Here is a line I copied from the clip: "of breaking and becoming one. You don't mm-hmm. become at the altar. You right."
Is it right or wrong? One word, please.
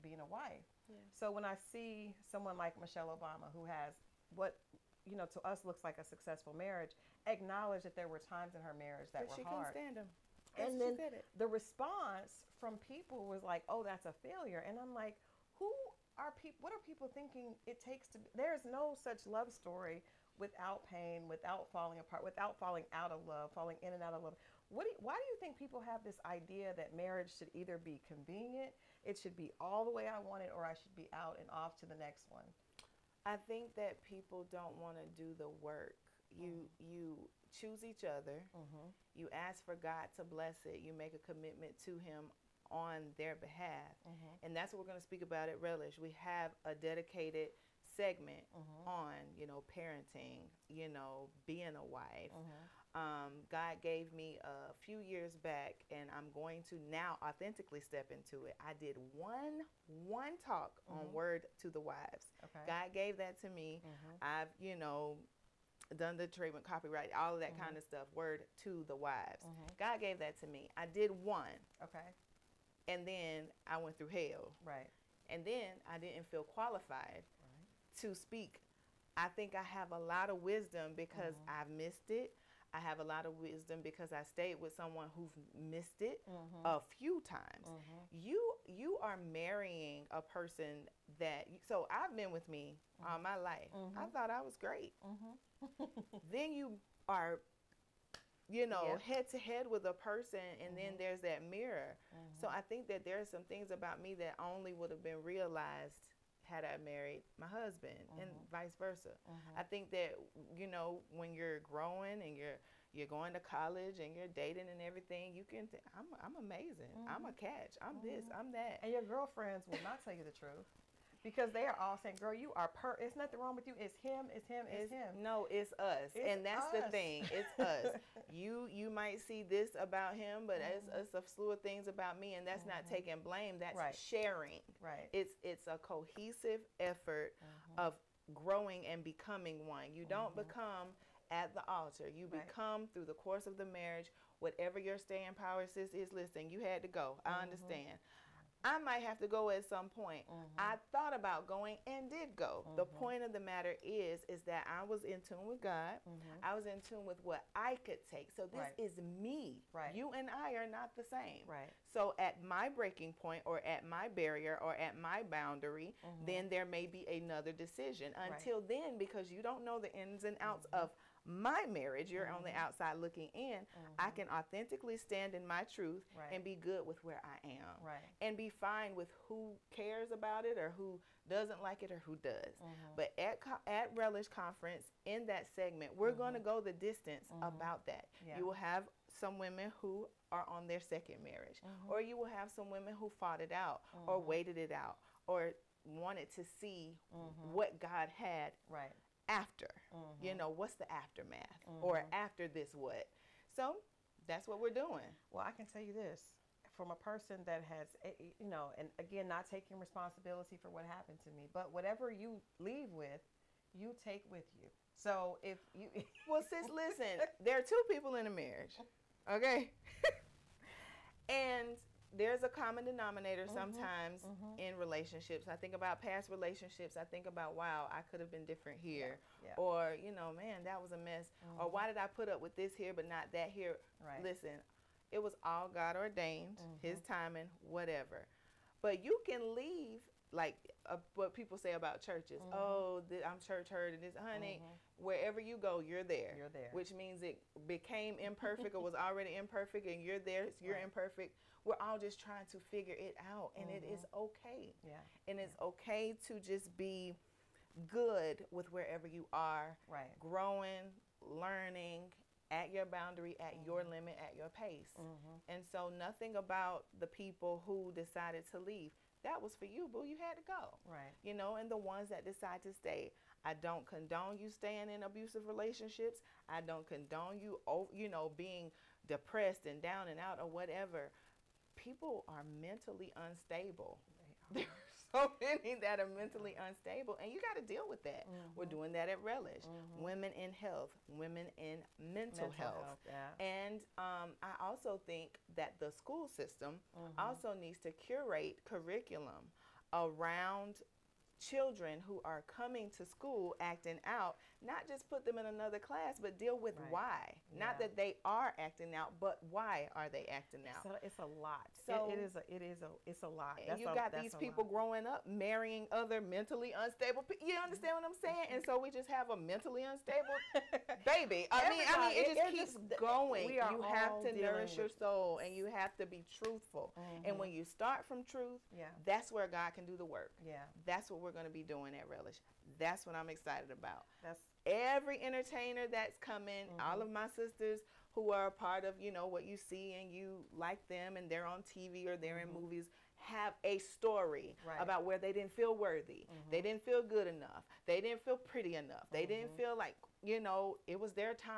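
wrong.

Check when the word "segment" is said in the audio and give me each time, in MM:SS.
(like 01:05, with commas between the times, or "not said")
00:47, 03:05.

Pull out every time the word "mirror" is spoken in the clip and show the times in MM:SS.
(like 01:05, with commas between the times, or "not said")
01:41.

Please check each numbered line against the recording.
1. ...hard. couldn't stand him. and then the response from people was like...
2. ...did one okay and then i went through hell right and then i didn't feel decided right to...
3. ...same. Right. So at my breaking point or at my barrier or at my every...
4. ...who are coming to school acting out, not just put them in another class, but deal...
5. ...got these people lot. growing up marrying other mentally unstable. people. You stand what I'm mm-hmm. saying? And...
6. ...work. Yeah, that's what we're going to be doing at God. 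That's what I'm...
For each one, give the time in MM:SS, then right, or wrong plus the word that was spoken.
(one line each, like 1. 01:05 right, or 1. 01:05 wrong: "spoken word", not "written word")
1. 00:09 right
2. 01:10 wrong: "qualified", not "decided"
3. 02:41 wrong: "boundary", not "every"
4. 05:02 right
5. 05:13 wrong: "understand", not "stand"
6. 05:30 wrong: "Relish", not "God".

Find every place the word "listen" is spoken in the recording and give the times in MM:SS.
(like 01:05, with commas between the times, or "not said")
02:26, 03:36, 03:54.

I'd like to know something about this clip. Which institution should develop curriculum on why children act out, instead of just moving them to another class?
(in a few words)
The school system.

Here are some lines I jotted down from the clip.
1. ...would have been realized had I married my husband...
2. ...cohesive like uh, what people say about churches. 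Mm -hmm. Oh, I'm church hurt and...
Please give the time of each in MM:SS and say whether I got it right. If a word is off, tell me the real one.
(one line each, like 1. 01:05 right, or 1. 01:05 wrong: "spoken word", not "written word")
1. 01:44 right
2. 03:59 wrong: "leave", not "cohesive".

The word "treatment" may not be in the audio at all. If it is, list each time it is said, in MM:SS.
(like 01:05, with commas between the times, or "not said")
01:06.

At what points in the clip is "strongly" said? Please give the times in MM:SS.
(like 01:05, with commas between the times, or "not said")
not said.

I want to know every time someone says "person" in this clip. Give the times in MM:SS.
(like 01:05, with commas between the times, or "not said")
01:30, 01:40, 03:26.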